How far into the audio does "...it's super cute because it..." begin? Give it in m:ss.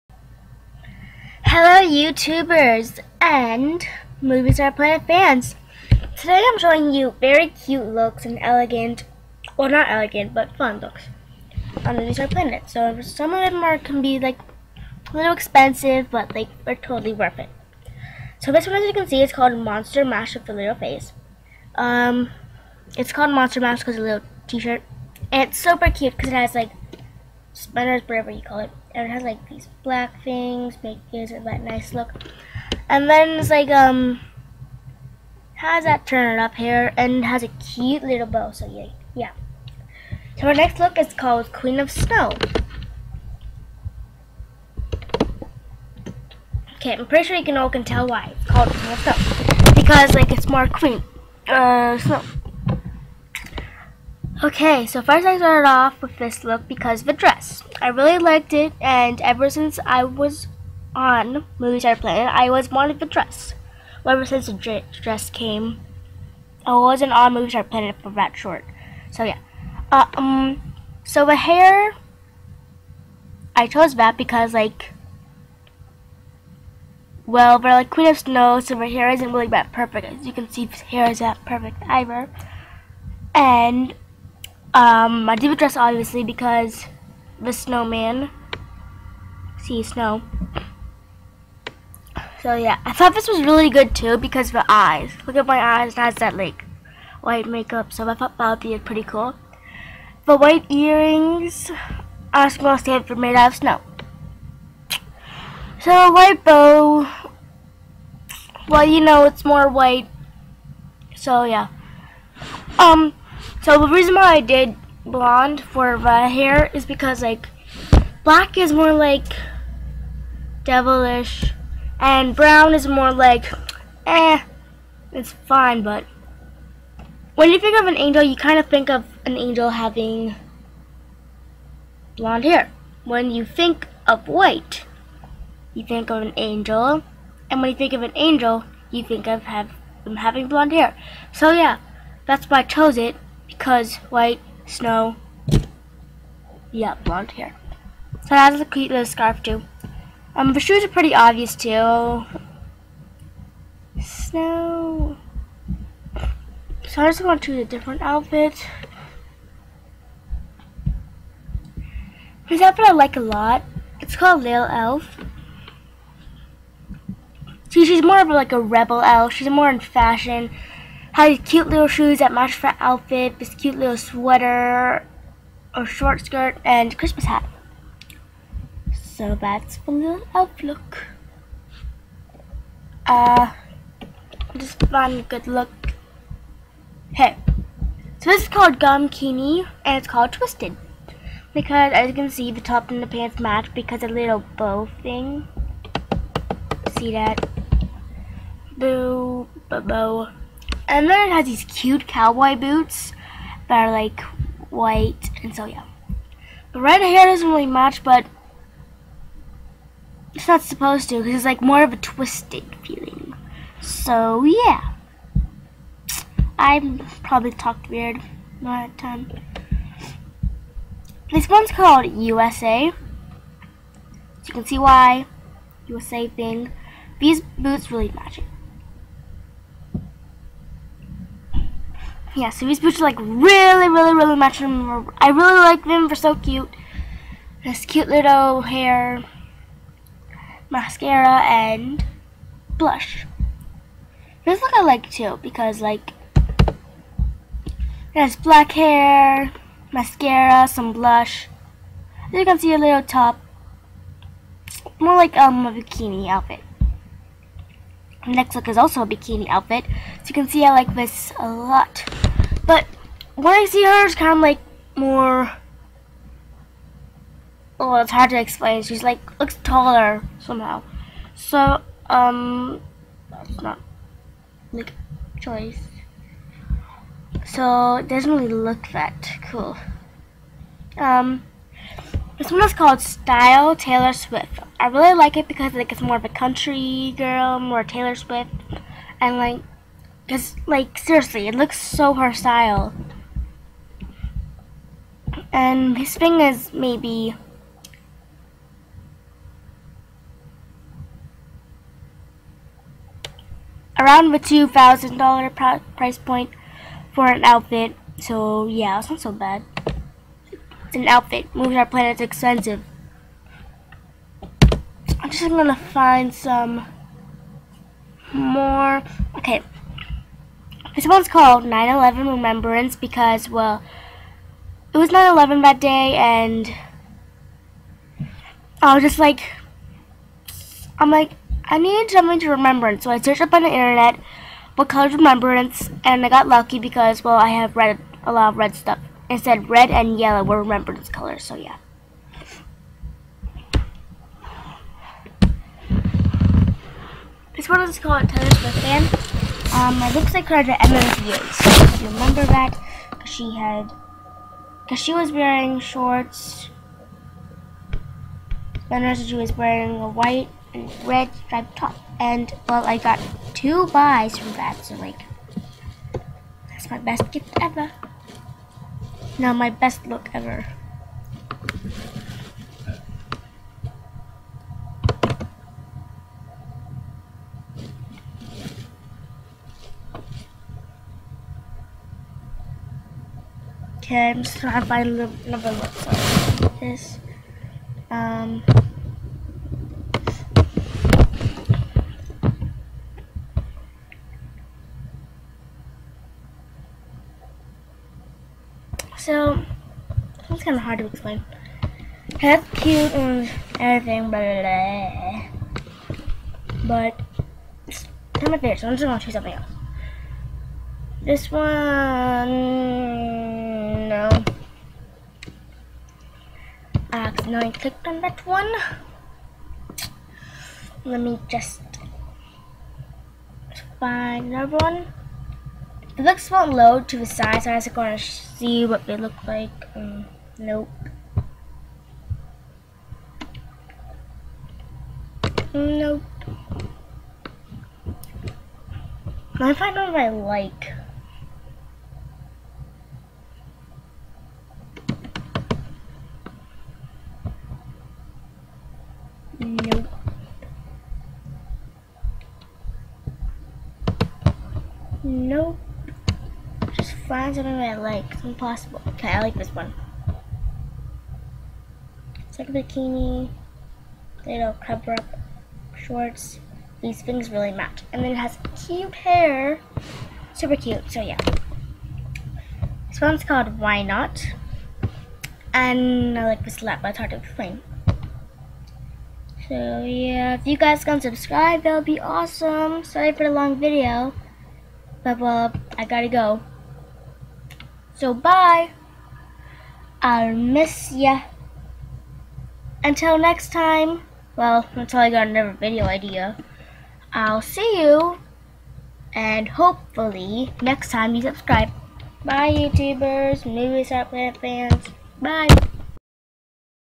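0:25.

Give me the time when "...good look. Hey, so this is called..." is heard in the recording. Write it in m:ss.
3:05.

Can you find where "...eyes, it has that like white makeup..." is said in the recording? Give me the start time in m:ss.
1:35.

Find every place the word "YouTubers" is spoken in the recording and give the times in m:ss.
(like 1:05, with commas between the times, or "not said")
0:01, 8:22.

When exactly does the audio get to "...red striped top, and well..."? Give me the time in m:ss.
6:01.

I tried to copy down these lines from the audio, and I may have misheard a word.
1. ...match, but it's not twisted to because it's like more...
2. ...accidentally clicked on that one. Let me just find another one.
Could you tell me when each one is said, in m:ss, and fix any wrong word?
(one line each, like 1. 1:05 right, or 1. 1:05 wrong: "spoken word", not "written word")
1. 3:27 wrong: "supposed", not "twisted"
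2. 6:57 right.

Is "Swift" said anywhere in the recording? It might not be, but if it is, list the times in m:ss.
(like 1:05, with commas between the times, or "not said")
4:44, 4:48, 5:48.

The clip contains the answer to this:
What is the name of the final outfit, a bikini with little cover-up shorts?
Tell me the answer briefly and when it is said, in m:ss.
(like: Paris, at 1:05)
Why Not, at 7:53.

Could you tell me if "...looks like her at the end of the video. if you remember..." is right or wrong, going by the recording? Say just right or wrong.
right.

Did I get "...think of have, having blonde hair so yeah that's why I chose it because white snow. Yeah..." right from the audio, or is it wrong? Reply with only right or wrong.
right.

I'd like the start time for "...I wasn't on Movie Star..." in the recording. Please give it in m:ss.
1:06.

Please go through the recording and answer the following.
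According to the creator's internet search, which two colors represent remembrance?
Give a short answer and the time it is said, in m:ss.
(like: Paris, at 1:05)
red and yellow, at 5:39.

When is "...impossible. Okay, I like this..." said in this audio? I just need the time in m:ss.
7:38.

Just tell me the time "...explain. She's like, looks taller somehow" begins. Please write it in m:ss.
4:28.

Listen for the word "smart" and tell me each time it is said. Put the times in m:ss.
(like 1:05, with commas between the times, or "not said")
not said.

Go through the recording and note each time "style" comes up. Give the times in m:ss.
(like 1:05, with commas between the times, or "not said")
4:42, 4:52.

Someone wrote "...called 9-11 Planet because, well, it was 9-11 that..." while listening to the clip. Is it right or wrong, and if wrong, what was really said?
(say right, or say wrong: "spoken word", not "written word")
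wrong: "Remembrance", not "Planet".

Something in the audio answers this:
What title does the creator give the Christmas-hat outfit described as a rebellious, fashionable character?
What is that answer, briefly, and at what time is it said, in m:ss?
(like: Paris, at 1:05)
Lil Elf, at 2:44.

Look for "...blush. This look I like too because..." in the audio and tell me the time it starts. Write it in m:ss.
4:02.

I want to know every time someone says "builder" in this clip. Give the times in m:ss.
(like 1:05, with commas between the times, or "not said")
not said.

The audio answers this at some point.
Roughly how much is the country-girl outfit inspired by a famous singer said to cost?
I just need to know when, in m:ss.
5:04.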